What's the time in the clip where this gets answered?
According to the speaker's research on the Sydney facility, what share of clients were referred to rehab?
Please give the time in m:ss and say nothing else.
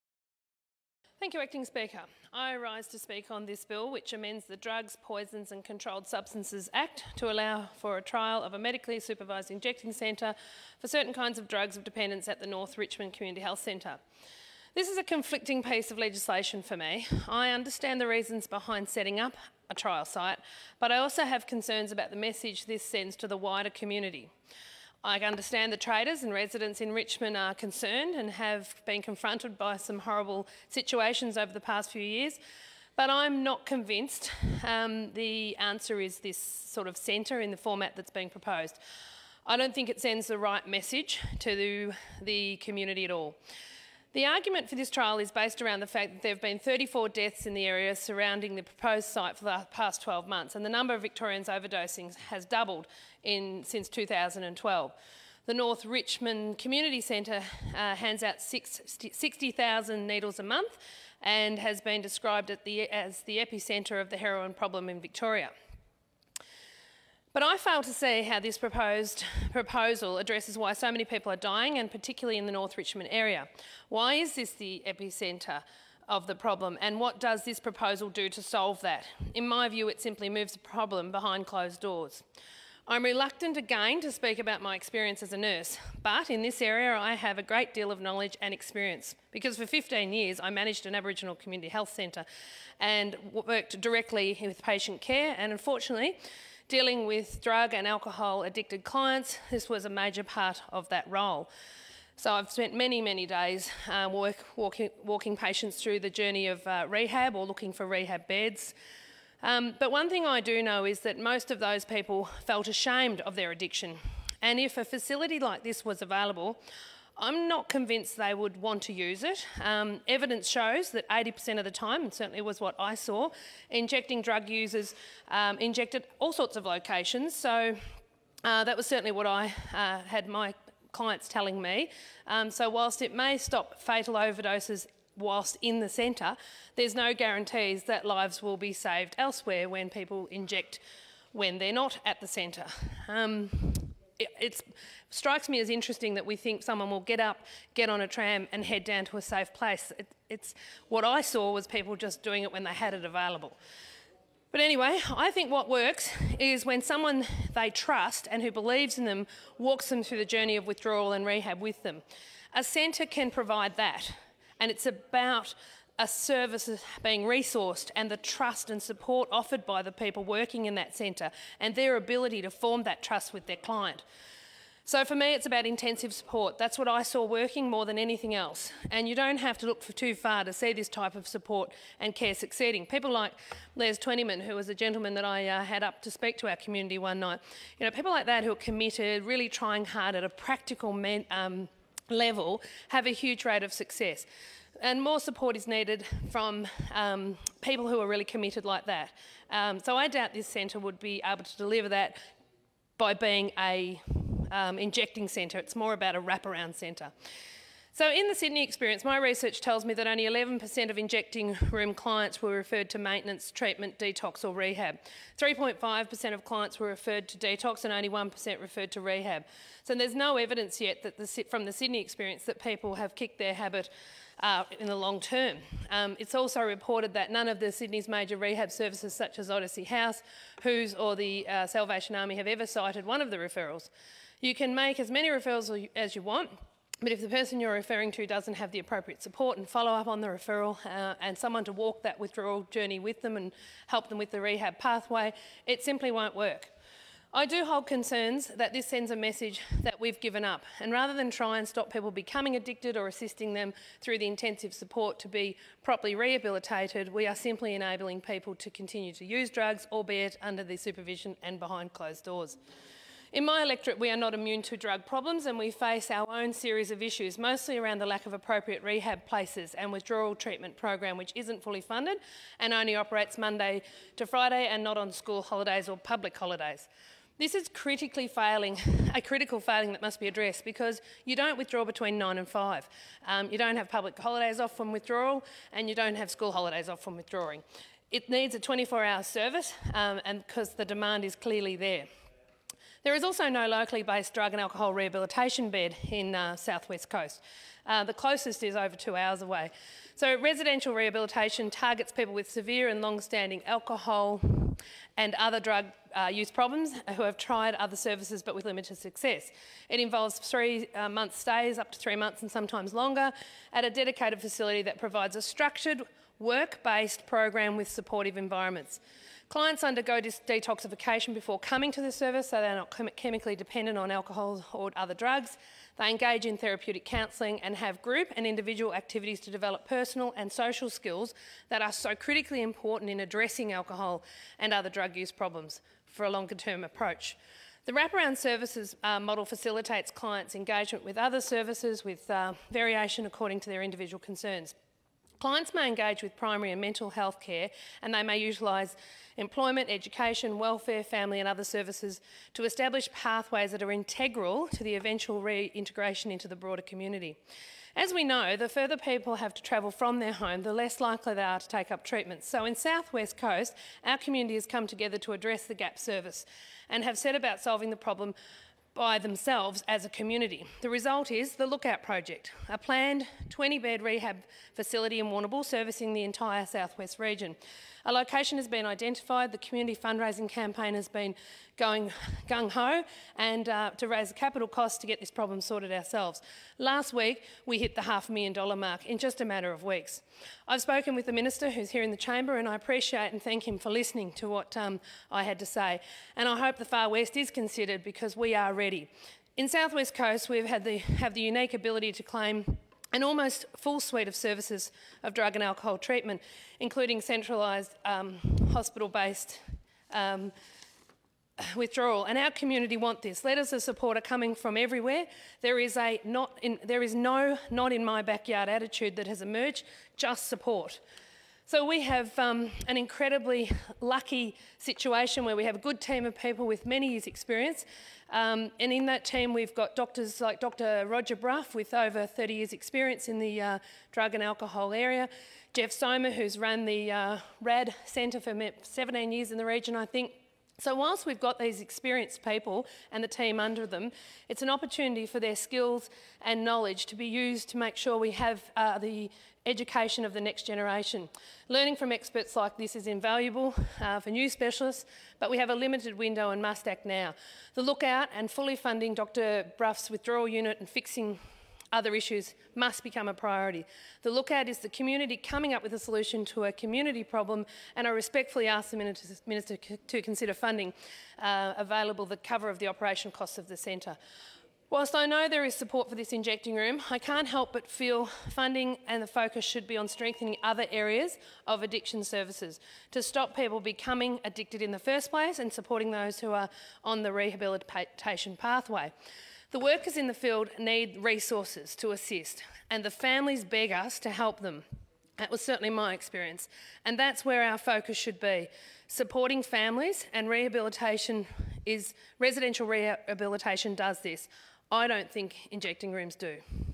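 3:38.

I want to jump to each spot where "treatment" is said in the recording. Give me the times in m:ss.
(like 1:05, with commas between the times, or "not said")
3:33, 4:30, 6:02, 6:45.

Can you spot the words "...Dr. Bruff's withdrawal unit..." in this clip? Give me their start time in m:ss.
7:39.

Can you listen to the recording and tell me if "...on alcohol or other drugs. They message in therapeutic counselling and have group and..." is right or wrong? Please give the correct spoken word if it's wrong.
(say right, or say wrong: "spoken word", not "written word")
wrong: "engage", not "message".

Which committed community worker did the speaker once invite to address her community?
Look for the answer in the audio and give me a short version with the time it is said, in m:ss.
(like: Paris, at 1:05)
Les Twentyman, at 3:03.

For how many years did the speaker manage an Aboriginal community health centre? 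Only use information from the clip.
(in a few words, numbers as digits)
15.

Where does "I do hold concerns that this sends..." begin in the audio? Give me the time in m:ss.
4:07.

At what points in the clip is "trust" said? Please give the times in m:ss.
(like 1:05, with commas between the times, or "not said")
2:37, 2:48, 2:53.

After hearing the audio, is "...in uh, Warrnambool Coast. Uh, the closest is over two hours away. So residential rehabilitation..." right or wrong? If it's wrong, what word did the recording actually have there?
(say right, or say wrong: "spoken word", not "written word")
wrong: "Southwest", not "Warrnambool".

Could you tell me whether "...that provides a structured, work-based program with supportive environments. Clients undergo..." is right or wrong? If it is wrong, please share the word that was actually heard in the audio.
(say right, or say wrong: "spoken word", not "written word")
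right.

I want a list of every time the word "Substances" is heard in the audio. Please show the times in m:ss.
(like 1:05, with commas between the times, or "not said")
0:06.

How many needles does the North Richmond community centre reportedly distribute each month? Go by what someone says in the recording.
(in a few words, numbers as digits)
60,000.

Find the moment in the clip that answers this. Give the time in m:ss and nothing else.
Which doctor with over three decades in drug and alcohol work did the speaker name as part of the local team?
7:10.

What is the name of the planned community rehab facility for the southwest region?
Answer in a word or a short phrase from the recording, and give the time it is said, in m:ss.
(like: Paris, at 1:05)
The Lookout Project, at 6:11.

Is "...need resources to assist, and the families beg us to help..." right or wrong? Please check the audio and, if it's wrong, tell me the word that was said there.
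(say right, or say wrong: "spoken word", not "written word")
right.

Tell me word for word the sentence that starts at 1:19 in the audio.
In my view, it simply moves the problem behind closed doors.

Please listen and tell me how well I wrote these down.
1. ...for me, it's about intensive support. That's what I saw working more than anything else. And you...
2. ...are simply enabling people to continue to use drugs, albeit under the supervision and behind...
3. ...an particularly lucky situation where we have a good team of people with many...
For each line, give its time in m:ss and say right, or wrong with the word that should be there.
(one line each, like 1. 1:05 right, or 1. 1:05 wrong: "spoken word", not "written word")
1. 2:55 right
2. 4:17 right
3. 7:02 wrong: "incredibly", not "particularly".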